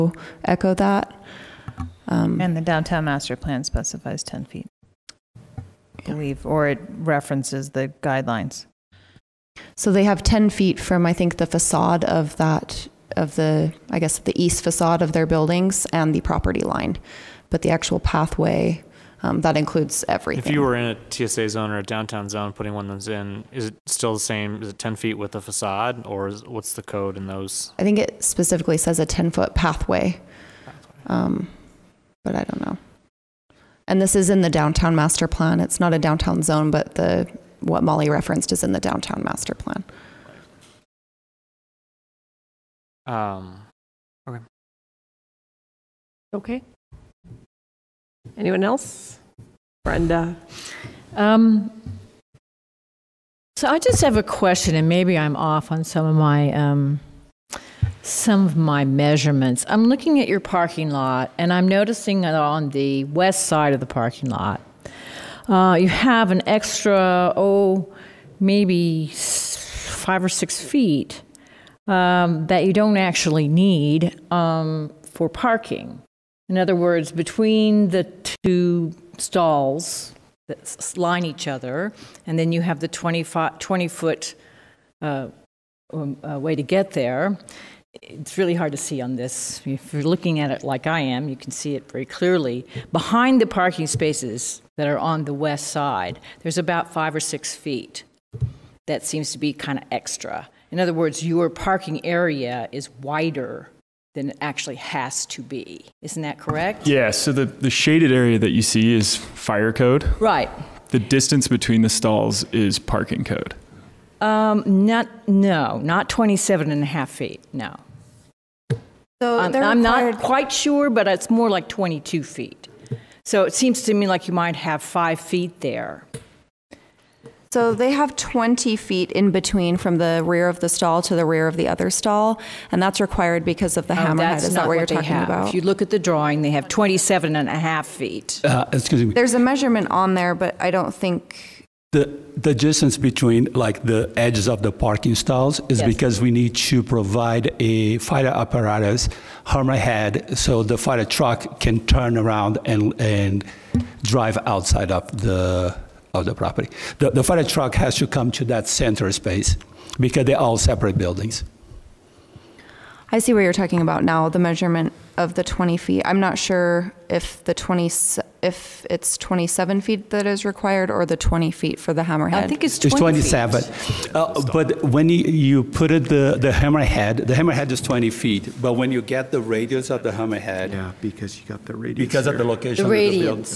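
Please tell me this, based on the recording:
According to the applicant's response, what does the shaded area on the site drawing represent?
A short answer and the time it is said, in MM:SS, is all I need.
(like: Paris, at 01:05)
fire code, at 01:47.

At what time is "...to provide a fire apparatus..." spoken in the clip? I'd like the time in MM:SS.
02:26.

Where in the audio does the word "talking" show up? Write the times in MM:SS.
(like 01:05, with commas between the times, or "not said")
02:14, 02:43.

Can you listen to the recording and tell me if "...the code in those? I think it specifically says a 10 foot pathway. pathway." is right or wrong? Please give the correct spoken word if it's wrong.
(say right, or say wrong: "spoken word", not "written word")
right.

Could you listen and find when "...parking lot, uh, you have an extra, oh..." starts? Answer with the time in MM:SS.
01:03.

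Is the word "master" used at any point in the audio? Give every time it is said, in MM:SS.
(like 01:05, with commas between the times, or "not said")
00:03, 00:34, 00:39.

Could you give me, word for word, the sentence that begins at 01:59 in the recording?
So I'm, I'm not quite sure, but it's more like 22 feet.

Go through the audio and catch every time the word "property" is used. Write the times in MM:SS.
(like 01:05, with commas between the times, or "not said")
00:16, 02:36.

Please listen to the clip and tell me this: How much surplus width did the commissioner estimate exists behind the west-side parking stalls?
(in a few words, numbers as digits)
5 or 6 feet.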